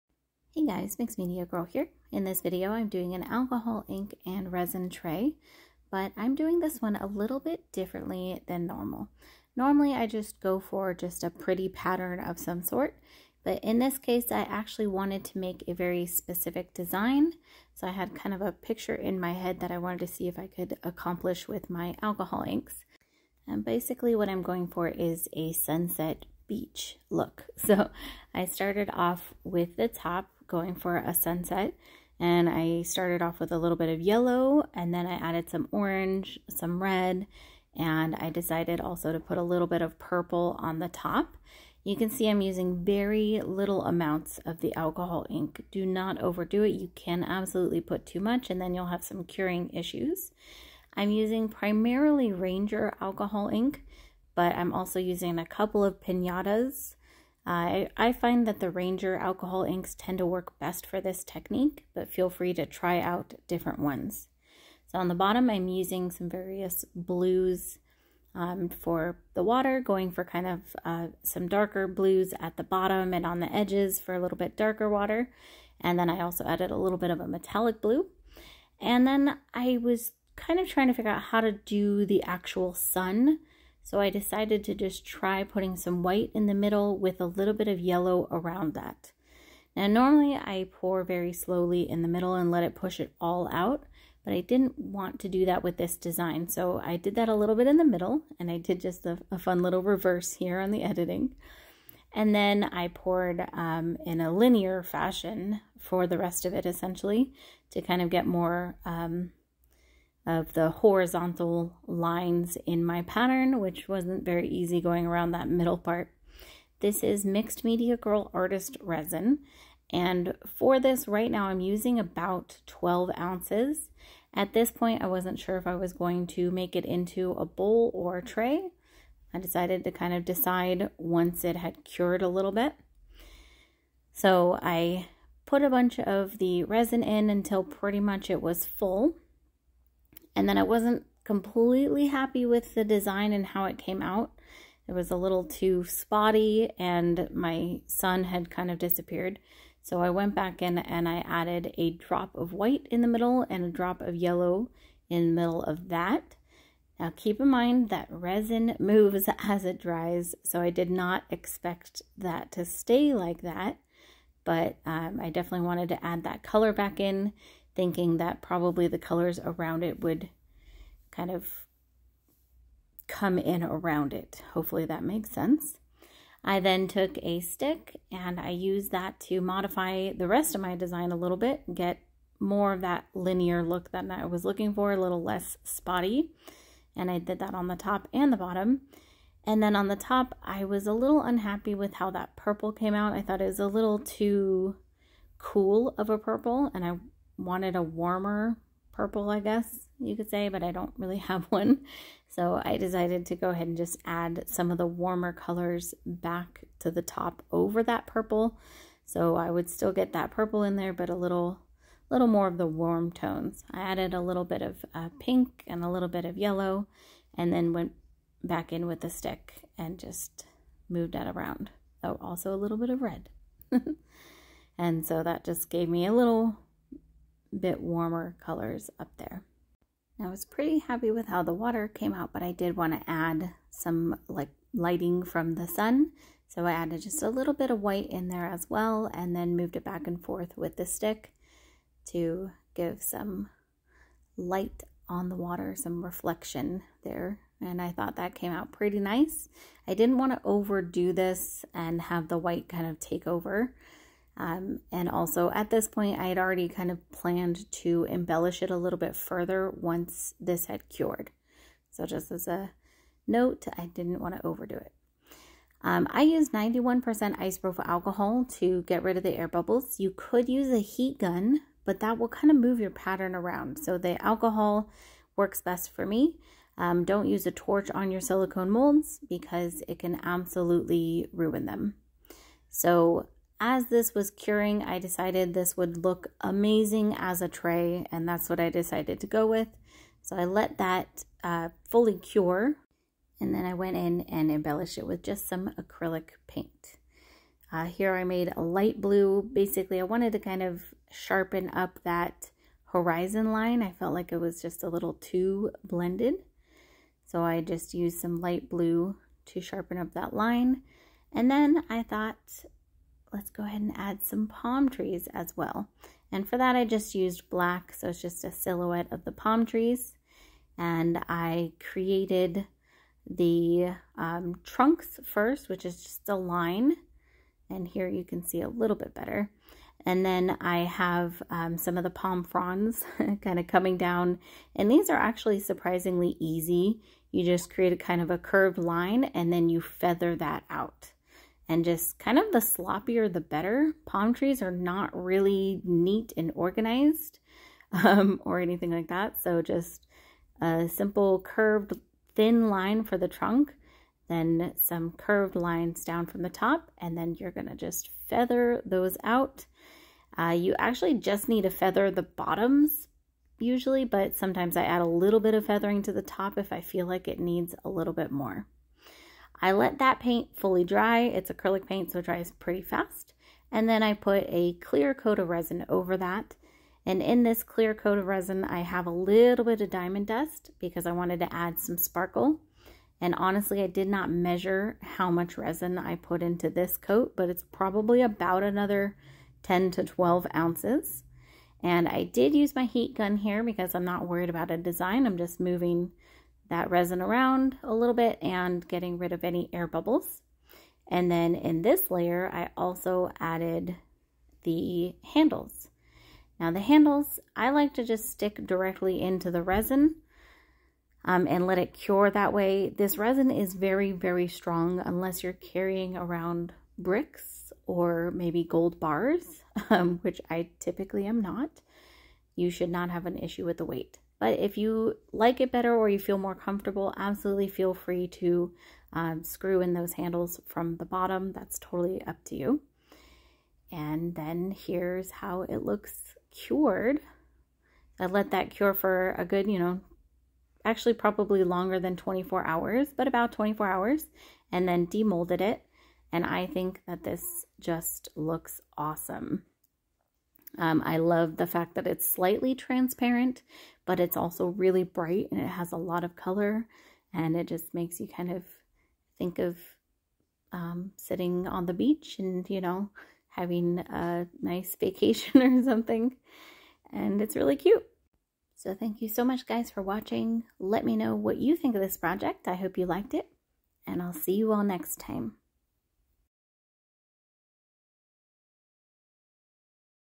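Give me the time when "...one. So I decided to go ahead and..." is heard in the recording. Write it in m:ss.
3:21.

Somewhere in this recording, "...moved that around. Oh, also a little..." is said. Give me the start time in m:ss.
3:40.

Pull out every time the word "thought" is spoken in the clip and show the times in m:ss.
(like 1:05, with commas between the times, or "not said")
3:13, 4:07, 5:12.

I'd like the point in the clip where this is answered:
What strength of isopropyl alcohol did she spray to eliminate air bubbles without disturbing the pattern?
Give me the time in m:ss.
4:26.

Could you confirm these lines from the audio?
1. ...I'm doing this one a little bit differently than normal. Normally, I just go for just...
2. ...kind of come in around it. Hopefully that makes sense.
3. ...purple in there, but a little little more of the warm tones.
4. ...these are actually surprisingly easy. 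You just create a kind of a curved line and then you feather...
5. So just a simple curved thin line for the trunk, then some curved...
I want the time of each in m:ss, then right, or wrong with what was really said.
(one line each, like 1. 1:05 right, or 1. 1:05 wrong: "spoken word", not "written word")
1. 0:06 right
2. 2:51 right
3. 3:30 right
4. 5:34 right
5. 5:49 right.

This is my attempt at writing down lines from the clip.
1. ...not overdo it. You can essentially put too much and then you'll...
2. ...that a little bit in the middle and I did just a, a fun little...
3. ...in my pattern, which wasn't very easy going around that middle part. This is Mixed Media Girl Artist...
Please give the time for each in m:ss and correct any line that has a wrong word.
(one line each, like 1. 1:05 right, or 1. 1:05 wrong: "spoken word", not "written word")
1. 0:45 wrong: "absolutely", not "essentially"
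2. 1:37 right
3. 1:52 right.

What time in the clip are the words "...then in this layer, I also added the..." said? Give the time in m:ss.
6:41.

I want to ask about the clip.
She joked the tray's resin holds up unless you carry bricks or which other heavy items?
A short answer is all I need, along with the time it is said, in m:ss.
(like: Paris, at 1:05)
gold bars, at 6:58.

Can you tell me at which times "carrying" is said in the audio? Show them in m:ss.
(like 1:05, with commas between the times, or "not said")
6:55.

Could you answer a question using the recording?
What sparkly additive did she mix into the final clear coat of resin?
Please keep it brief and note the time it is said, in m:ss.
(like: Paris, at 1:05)
diamond dust, at 6:19.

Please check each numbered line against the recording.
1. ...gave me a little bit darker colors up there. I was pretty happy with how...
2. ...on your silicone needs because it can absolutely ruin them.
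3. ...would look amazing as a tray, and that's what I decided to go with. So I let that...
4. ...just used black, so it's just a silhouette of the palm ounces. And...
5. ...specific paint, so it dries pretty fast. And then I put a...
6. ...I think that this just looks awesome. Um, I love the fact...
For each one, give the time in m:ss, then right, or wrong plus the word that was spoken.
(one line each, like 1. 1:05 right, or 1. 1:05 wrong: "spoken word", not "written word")
1. 3:45 wrong: "warmer", not "darker"
2. 4:37 wrong: "molds", not "needs"
3. 4:45 right
4. 5:16 wrong: "trees", not "ounces"
5. 6:11 wrong: "acrylic", not "specific"
6. 7:26 right.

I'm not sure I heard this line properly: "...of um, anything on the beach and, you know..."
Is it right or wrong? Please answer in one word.
wrong.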